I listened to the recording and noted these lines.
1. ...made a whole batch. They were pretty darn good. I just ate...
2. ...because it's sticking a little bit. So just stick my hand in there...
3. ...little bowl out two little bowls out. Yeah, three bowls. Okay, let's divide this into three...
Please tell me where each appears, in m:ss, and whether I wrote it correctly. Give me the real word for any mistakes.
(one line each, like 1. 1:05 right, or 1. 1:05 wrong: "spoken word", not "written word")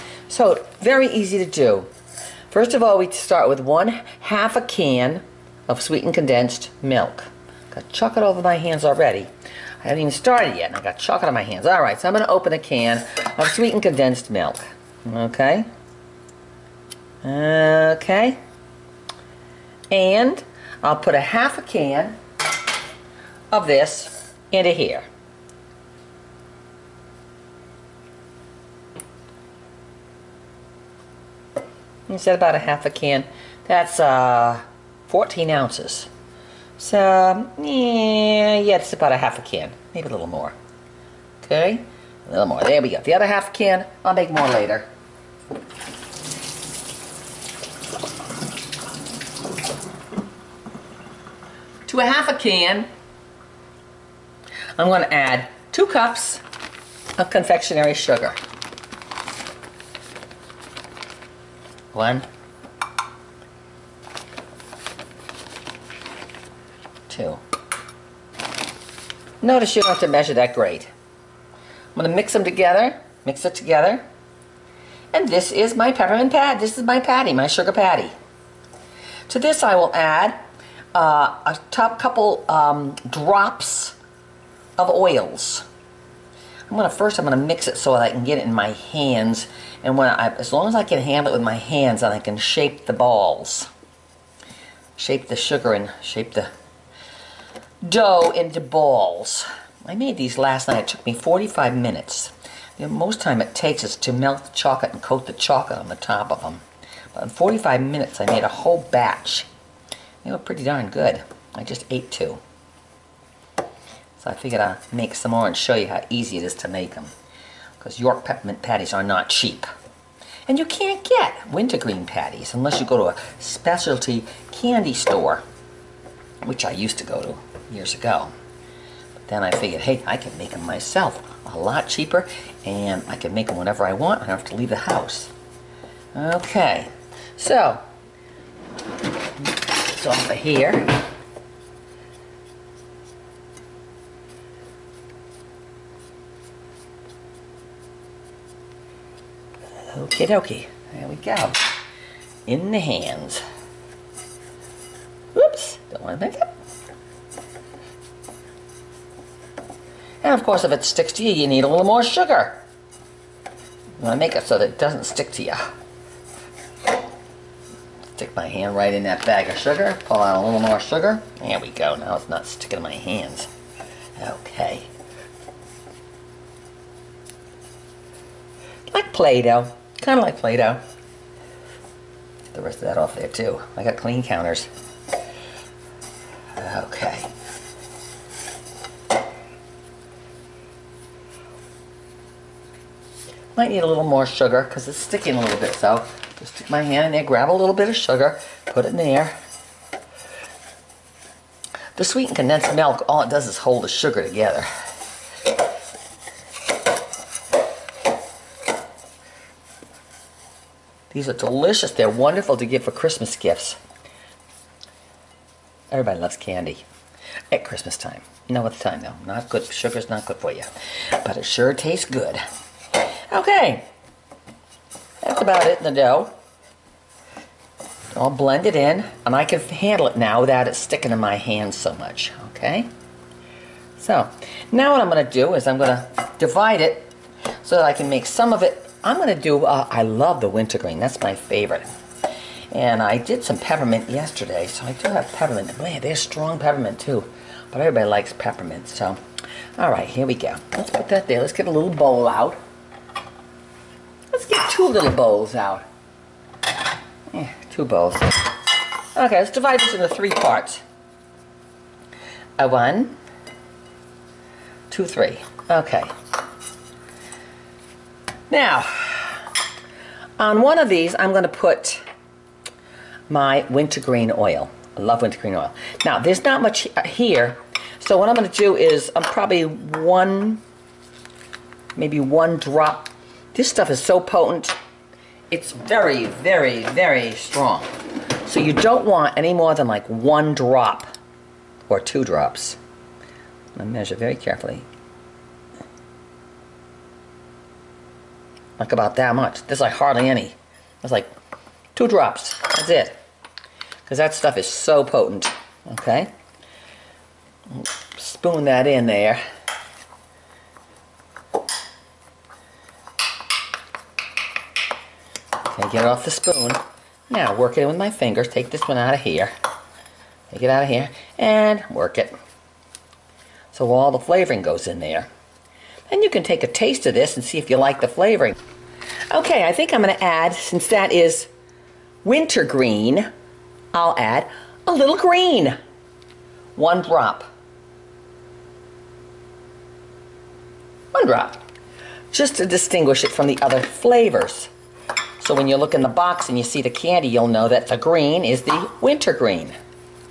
1. 1:48 right
2. 3:14 right
3. 4:11 wrong: "two", not "three".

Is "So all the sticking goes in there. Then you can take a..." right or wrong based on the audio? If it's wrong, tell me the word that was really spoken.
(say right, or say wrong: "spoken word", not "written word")
wrong: "flavoring", not "sticking".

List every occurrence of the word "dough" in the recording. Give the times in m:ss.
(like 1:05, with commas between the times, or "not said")
1:37, 3:45.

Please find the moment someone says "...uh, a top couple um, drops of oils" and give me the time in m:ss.
1:20.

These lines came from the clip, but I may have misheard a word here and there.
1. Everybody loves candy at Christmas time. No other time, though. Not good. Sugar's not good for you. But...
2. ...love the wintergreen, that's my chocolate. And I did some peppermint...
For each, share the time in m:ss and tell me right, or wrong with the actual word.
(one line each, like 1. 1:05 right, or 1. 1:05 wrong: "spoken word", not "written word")
1. 3:35 right
2. 4:00 wrong: "favorite", not "chocolate".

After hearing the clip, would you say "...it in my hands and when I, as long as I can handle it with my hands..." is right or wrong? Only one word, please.
right.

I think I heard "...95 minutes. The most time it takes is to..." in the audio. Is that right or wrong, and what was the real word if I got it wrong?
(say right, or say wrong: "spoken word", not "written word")
wrong: "45", not "95".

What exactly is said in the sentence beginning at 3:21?
The sweetened condensed milk, all it does is hold the sugar together.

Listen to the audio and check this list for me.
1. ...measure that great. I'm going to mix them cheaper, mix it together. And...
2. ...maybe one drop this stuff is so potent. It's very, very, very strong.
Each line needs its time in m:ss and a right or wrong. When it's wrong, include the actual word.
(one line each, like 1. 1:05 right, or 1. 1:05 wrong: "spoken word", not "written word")
1. 1:10 wrong: "together", not "cheaper"
2. 4:41 right.